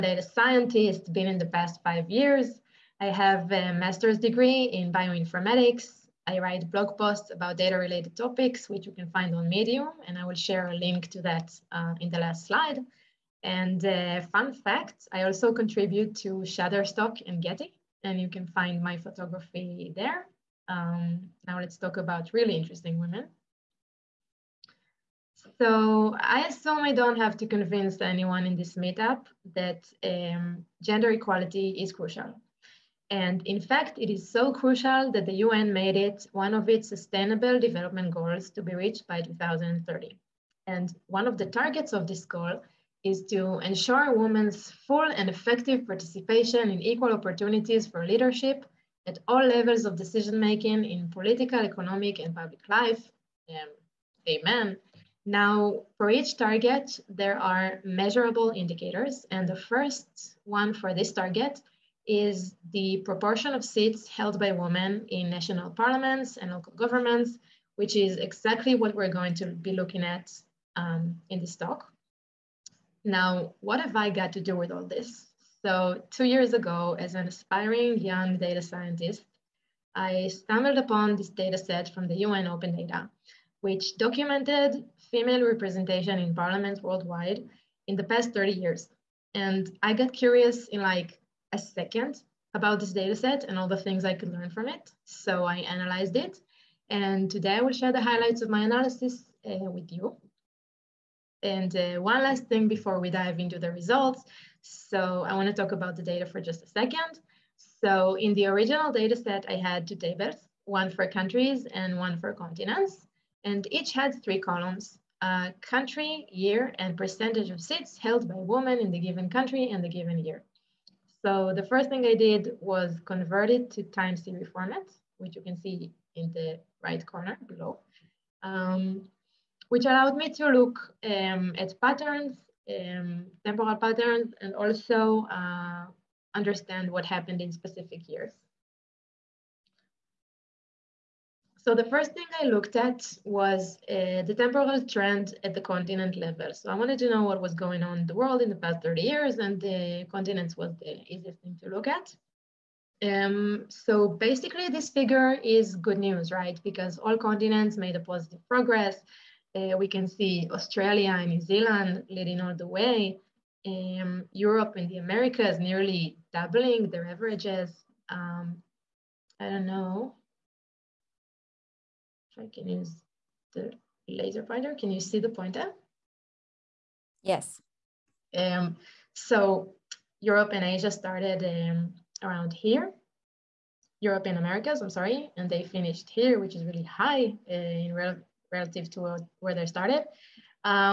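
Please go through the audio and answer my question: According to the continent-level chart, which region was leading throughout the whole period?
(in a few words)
Australia and New Zealand.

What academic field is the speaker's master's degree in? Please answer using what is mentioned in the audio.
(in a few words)
Bioinformatics.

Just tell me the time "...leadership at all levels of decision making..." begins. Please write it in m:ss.
0:48.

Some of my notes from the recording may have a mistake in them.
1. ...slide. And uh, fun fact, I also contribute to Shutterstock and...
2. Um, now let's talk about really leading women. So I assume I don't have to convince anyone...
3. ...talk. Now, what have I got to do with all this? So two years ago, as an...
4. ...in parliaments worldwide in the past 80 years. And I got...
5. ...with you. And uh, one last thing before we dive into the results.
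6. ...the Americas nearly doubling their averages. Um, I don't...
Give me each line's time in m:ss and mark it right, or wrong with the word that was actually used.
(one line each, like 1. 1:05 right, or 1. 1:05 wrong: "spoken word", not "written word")
1. 0:12 right
2. 0:20 wrong: "interesting", not "leading"
3. 1:11 right
4. 1:26 wrong: "30", not "80"
5. 1:39 right
6. 2:44 right.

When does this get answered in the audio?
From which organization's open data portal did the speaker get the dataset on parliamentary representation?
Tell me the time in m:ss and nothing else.
1:22.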